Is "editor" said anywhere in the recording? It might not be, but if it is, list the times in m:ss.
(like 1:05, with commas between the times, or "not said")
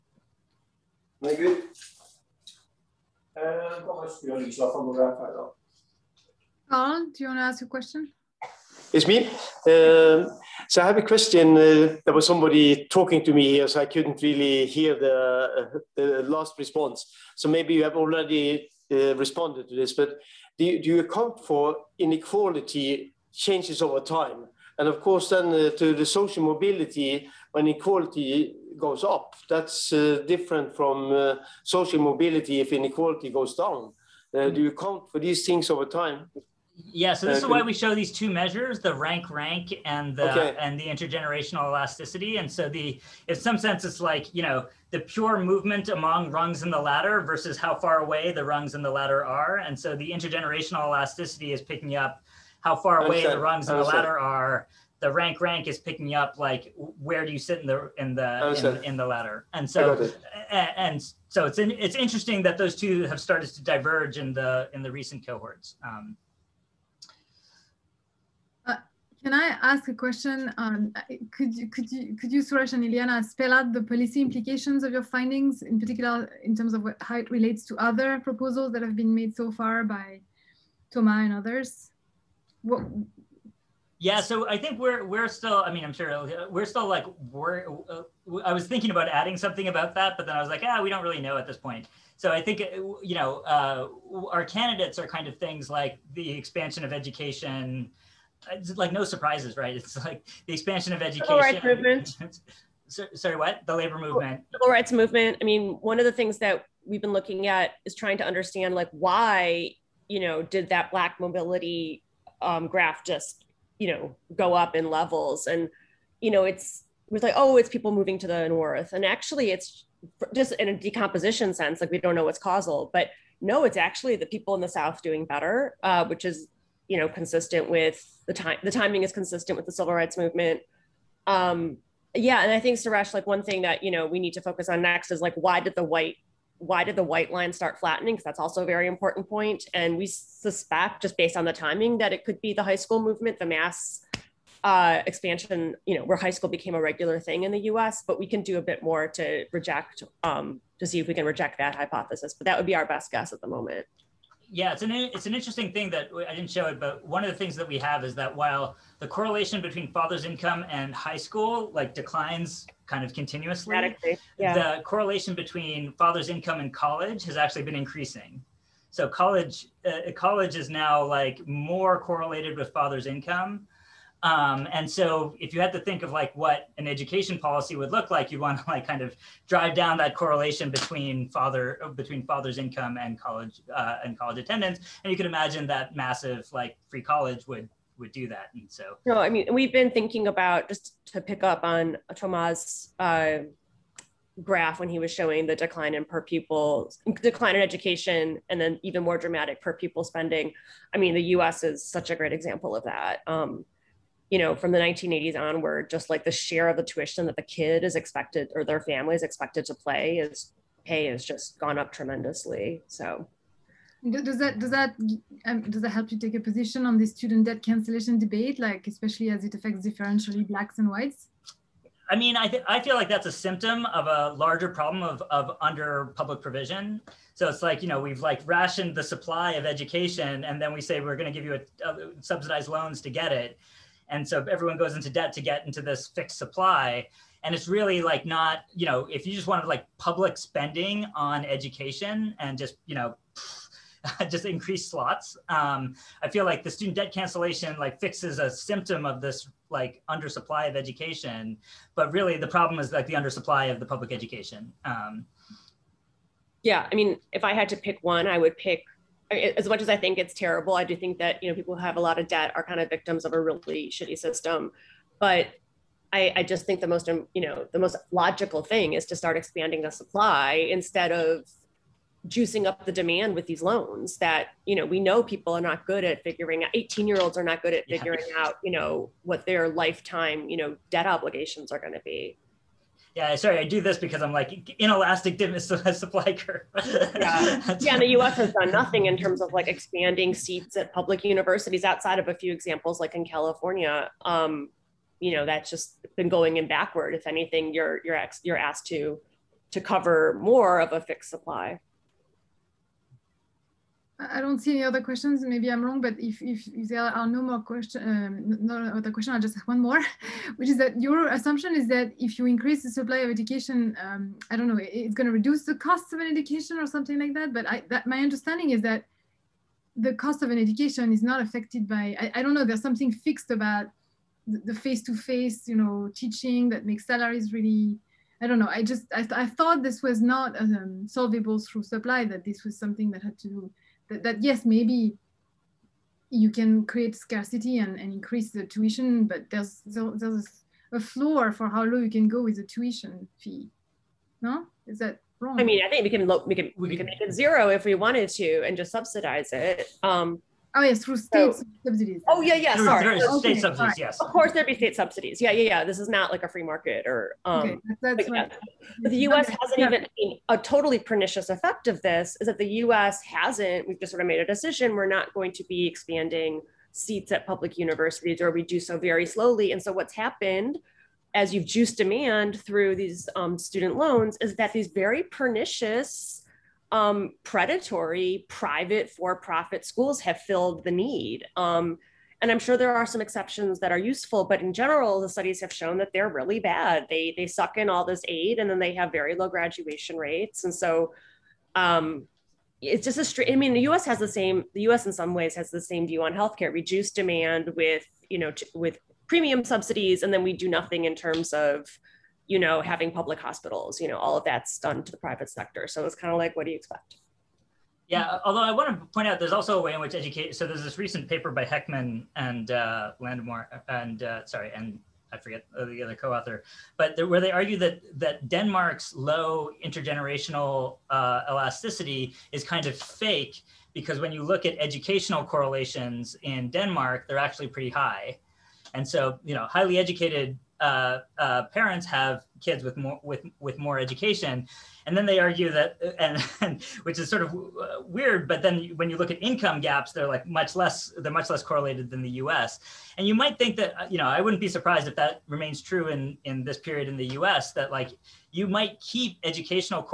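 not said.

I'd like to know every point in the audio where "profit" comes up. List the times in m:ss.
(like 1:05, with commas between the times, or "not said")
6:19.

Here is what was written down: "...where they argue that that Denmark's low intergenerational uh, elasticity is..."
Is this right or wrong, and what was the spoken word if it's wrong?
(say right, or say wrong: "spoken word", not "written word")
right.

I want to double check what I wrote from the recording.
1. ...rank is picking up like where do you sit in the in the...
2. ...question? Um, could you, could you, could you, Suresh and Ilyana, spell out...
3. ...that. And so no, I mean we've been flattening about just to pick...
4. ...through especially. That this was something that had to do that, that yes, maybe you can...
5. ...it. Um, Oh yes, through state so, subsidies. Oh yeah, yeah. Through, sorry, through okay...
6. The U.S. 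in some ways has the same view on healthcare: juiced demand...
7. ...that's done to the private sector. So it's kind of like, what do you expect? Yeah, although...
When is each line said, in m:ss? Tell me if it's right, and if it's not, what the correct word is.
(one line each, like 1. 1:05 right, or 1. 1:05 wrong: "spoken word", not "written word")
1. 0:55 right
2. 1:09 right
3. 3:08 wrong: "thinking", not "flattening"
4. 5:31 wrong: "supply", not "especially"
5. 5:49 right
6. 6:34 wrong: "reduced", not "juiced"
7. 6:44 right.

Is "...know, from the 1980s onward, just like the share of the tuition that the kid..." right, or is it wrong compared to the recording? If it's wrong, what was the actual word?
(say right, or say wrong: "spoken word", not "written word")
right.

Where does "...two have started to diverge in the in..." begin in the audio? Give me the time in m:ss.
1:02.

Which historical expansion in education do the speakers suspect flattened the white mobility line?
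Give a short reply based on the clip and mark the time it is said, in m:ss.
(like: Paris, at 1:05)
The high school movement, at 2:22.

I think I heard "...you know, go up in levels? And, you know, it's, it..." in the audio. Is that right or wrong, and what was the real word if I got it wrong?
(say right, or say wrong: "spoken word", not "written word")
right.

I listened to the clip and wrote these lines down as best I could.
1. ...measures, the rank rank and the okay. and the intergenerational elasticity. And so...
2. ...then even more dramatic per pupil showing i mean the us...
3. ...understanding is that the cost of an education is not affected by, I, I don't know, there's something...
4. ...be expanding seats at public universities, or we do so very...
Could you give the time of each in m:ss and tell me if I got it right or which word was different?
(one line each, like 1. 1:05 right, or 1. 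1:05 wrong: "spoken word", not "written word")
1. 0:38 right
2. 3:18 wrong: "spending", not "showing"
3. 5:18 right
4. 6:05 right.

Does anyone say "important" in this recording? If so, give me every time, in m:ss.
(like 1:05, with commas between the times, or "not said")
2:18.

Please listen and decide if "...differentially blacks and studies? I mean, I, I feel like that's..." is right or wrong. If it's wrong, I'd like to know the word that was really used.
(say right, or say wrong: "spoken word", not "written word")
wrong: "whites", not "studies".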